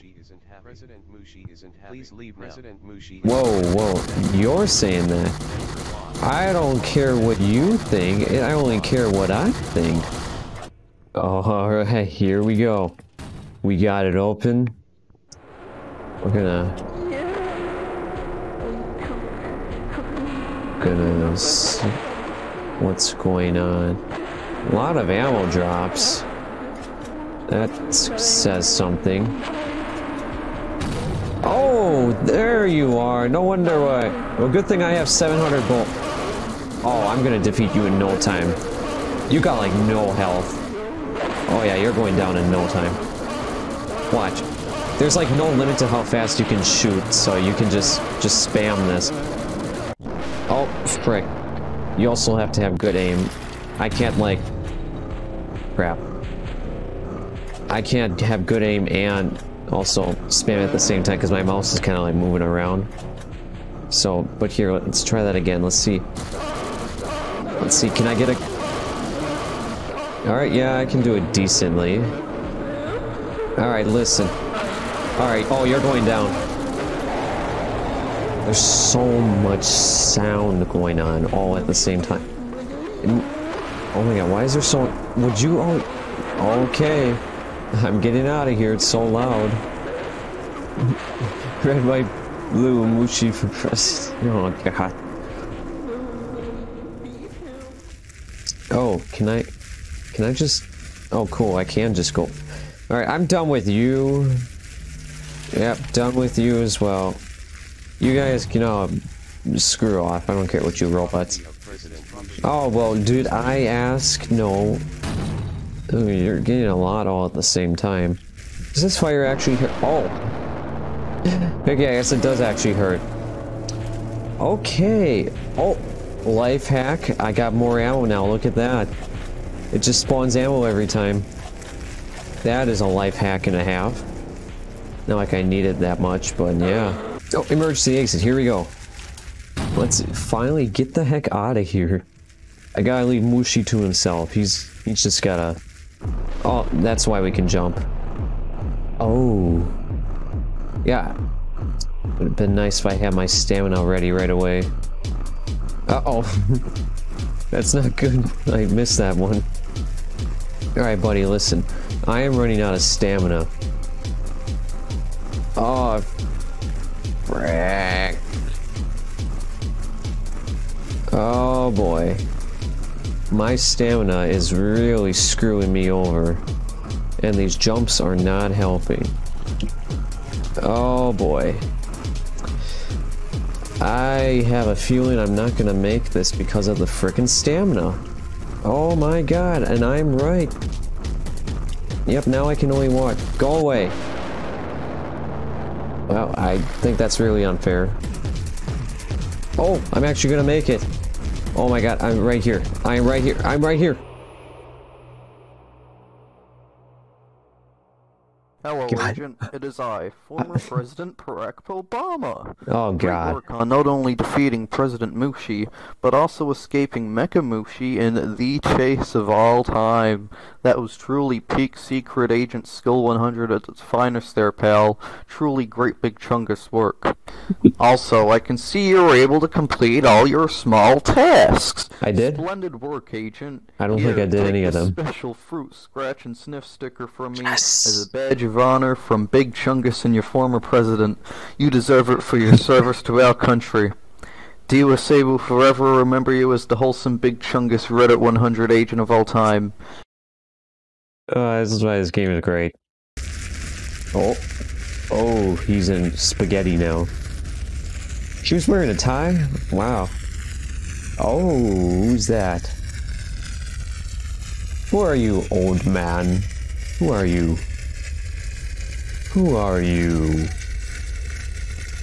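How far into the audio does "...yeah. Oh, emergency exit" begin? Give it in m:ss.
2:16.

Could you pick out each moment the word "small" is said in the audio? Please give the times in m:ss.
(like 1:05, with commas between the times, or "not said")
3:50.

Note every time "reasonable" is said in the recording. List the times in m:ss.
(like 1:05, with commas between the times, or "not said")
not said.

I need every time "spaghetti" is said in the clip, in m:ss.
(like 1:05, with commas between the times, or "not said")
4:16.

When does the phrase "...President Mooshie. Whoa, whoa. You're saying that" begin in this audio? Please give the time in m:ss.
0:02.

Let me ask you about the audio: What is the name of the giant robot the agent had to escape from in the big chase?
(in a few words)
Mecha Mooshie.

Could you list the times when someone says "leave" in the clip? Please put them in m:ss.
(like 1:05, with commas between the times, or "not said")
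0:02, 2:23.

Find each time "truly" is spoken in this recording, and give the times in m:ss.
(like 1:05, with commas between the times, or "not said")
3:40, 3:45.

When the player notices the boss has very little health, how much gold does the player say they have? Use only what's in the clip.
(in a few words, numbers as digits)
700.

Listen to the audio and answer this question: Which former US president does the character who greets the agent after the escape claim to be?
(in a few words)
Barack Obama.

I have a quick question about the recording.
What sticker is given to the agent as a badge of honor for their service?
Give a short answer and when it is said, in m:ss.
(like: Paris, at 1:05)
special fruit scratch and sniff sticker, at 3:54.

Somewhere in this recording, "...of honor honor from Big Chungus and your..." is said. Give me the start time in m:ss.
3:58.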